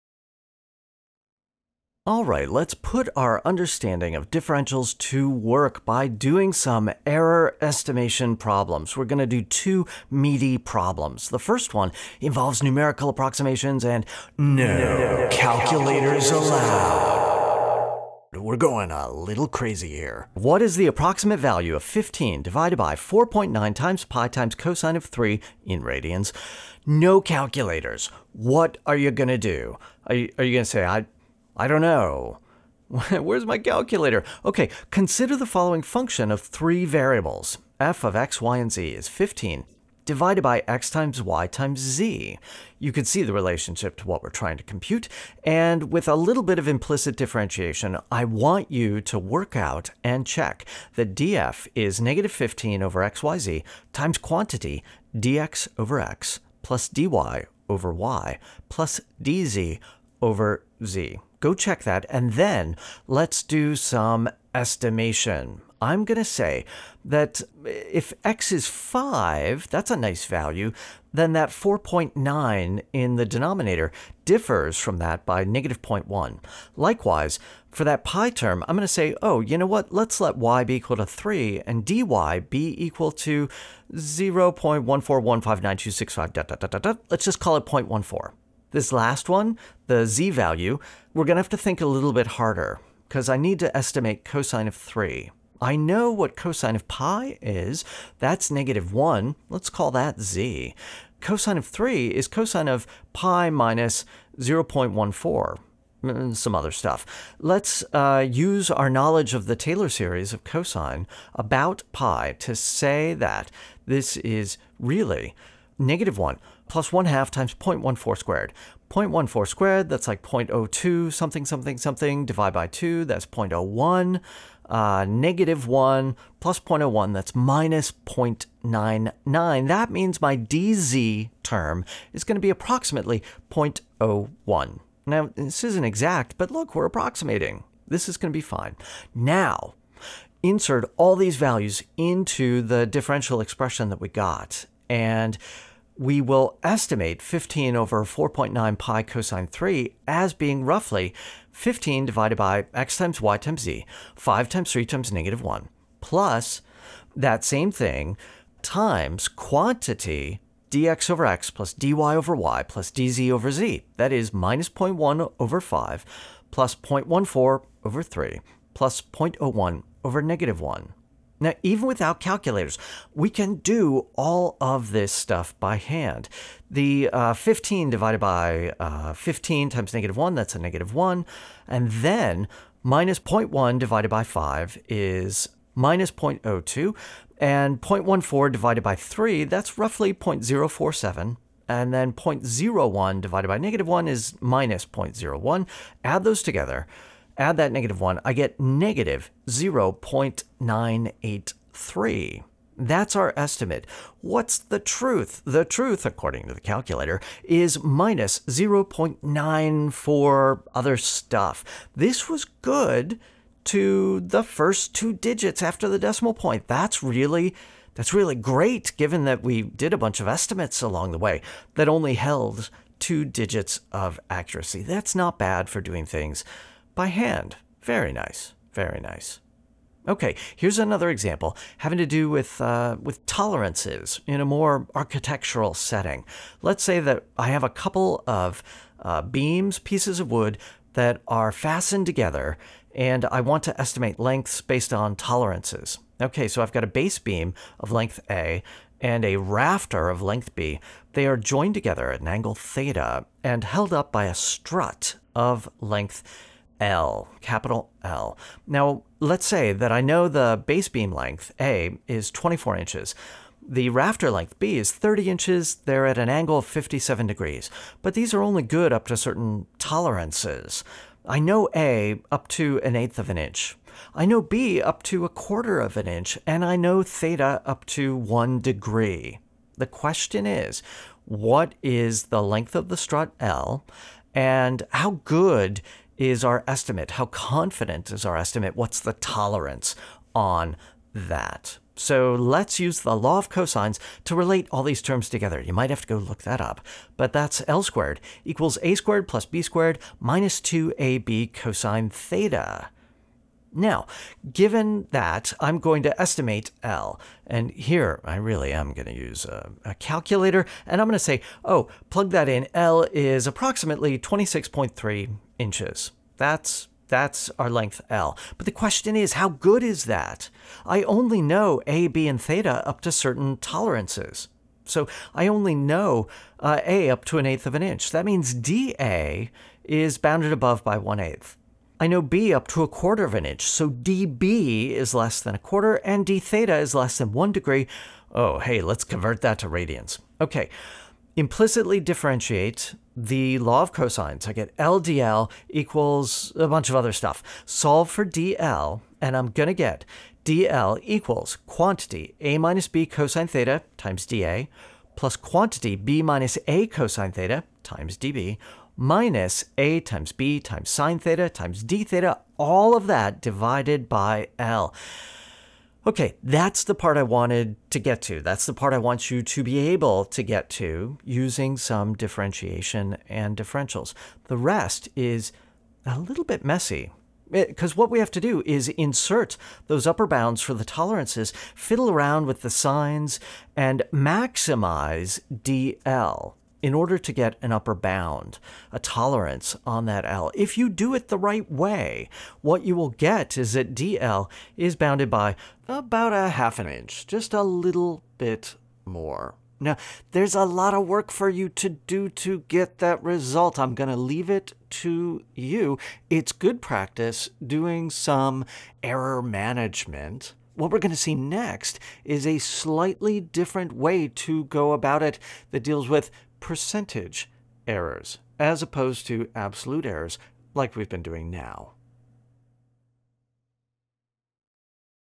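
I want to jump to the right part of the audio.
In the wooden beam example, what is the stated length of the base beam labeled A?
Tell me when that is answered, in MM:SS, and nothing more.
04:22.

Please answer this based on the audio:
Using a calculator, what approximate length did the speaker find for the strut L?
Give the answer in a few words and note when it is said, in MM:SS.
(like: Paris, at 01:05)
26.3 inches, at 05:14.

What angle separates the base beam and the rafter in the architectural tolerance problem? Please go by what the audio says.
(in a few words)
57 degrees.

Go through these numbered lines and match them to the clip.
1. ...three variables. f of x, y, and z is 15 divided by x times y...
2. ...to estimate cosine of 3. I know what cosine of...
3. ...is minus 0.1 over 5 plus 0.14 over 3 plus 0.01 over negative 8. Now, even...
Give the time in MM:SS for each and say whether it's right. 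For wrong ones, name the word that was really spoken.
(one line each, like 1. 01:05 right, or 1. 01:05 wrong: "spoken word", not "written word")
1. 00:36 right
2. 01:33 right
3. 02:44 wrong: "1", not "8".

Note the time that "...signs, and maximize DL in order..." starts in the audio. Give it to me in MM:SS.
06:22.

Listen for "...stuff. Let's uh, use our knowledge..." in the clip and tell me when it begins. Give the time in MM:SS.
01:46.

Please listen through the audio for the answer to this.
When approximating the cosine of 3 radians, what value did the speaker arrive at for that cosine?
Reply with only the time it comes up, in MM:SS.
02:07.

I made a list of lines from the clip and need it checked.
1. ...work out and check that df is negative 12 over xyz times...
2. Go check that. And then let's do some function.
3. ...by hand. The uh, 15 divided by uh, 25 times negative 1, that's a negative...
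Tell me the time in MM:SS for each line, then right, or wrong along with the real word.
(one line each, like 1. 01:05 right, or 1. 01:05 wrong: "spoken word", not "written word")
1. 00:49 wrong: "15", not "12"
2. 01:01 wrong: "estimation", not "function"
3. 02:55 wrong: "15", not "25".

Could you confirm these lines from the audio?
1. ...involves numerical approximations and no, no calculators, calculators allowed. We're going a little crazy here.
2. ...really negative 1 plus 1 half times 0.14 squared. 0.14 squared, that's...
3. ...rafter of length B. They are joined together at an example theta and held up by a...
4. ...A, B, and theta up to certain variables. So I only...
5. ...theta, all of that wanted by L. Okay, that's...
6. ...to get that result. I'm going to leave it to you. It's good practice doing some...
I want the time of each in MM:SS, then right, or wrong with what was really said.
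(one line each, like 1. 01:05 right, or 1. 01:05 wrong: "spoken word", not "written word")
1. 00:12 right
2. 01:54 right
3. 04:09 wrong: "angle", not "example"
4. 05:21 wrong: "tolerances", not "variables"
5. 06:02 wrong: "divided", not "wanted"
6. 06:42 right.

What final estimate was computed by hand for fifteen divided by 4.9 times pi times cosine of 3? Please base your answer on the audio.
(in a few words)
-0.983.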